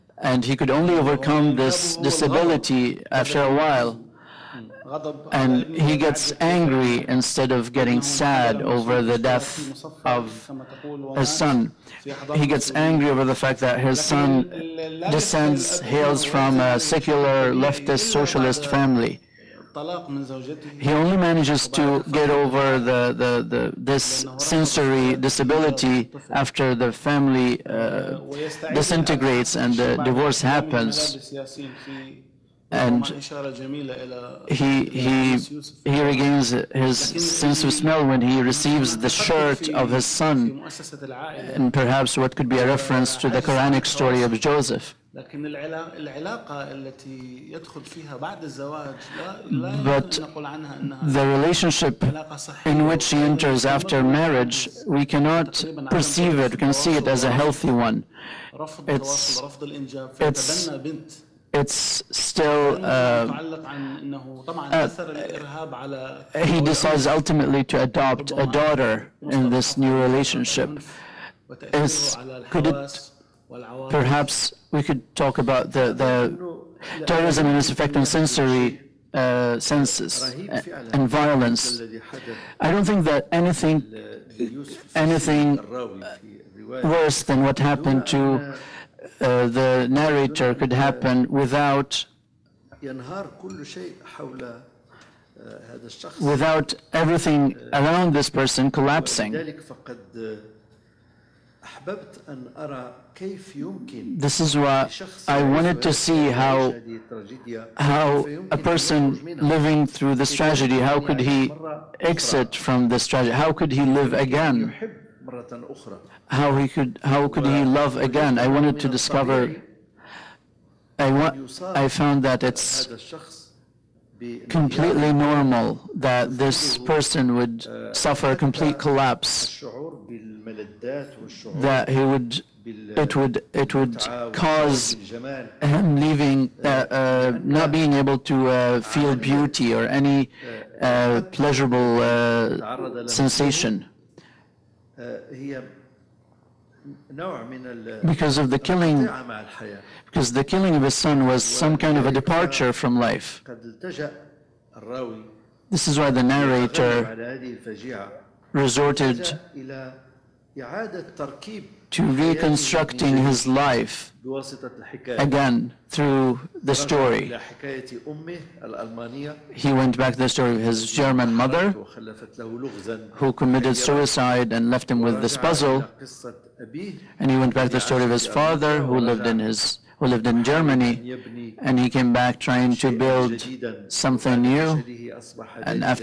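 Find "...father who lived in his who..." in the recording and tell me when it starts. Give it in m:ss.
2:58.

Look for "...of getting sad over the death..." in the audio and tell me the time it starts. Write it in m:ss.
0:07.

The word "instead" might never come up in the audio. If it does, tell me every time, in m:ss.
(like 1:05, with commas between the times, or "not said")
0:07.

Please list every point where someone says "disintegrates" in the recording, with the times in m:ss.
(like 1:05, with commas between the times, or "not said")
0:28.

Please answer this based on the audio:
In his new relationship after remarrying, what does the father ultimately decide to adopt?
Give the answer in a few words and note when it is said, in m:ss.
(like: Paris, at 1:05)
A daughter, at 1:08.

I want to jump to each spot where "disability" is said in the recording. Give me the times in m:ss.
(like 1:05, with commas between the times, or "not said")
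0:01, 0:25.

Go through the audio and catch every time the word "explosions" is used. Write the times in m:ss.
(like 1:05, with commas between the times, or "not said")
not said.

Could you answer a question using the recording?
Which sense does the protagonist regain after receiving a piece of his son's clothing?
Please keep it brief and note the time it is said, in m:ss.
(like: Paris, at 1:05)
Sense of smell, at 0:37.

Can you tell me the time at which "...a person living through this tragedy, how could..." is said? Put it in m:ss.
1:48.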